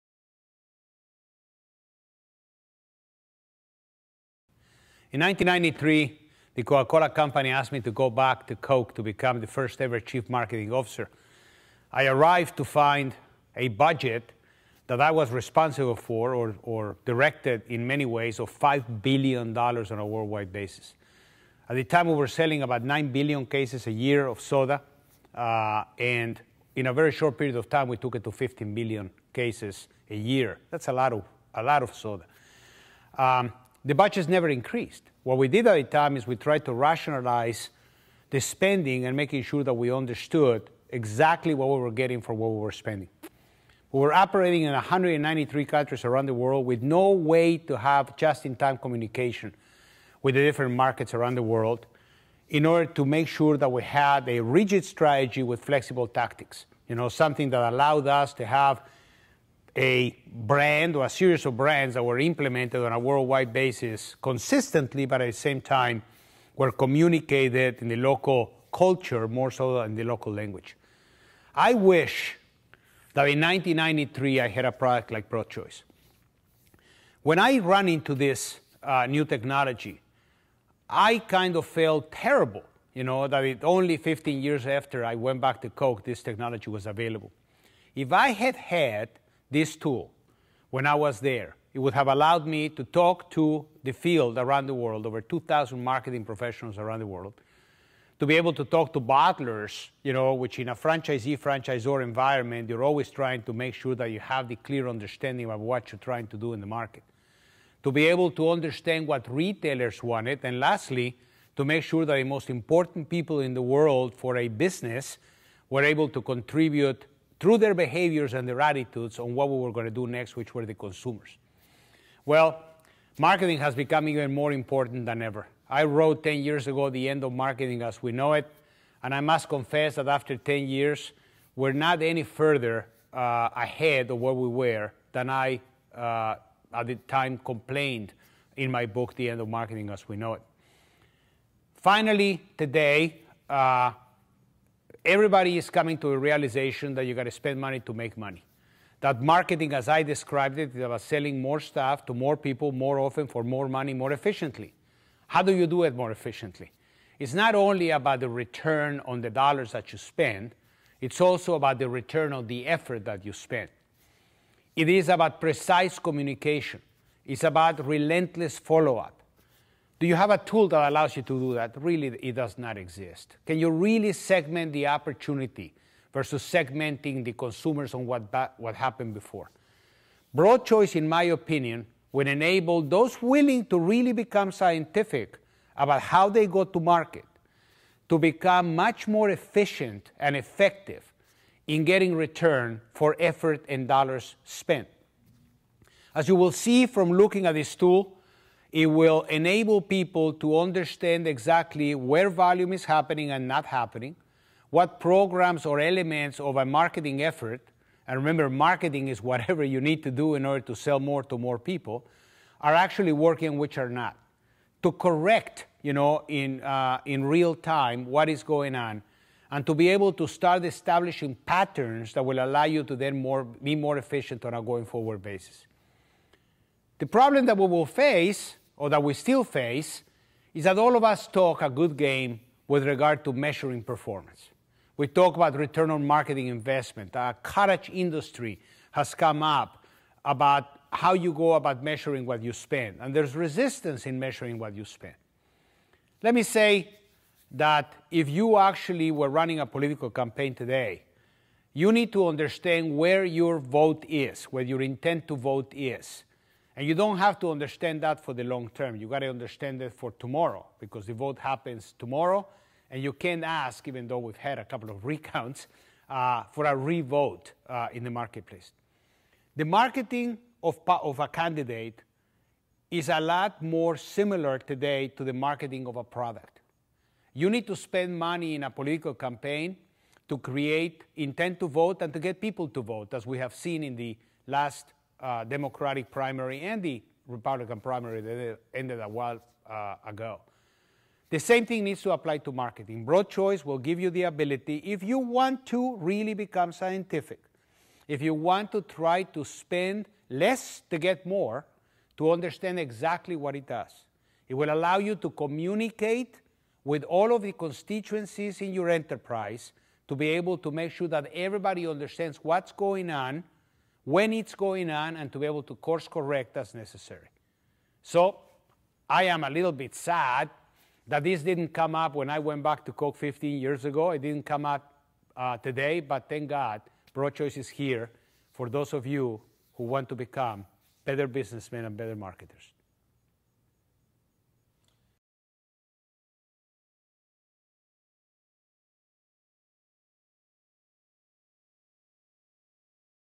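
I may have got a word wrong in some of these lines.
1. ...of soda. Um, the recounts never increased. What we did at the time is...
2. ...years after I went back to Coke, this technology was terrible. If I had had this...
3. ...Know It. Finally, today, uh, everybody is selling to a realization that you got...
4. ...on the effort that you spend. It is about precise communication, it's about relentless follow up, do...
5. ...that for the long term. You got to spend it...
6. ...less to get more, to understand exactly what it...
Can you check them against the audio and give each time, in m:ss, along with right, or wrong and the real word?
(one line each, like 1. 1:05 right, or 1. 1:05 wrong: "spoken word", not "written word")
1. 0:31 wrong: "budgets", not "recounts"
2. 1:24 wrong: "available", not "terrible"
3. 2:20 wrong: "coming", not "selling"
4. 2:42 right
5. 4:18 wrong: "understand", not "spend"
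6. 5:00 right.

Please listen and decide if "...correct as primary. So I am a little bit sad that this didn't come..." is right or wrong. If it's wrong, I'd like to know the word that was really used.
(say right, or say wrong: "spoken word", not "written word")
wrong: "necessary", not "primary".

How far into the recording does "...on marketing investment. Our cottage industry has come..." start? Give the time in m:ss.
3:55.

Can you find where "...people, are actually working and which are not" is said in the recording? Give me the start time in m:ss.
3:31.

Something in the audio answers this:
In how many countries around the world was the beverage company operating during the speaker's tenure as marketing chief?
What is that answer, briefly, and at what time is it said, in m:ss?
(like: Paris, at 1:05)
193, at 0:44.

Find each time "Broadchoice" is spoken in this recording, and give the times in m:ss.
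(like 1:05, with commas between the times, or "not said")
1:15, 3:00, 4:53, 5:27.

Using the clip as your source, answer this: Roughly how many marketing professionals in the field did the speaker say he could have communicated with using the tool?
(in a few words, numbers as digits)
over 2,000.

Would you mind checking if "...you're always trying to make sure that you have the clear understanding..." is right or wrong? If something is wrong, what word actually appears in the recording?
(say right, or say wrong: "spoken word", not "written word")
right.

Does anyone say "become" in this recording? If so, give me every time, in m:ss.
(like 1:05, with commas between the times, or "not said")
0:09, 2:03, 3:04, 3:08, 4:56, 5:30.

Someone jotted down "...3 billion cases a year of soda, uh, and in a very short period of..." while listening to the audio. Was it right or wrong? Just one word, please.
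wrong.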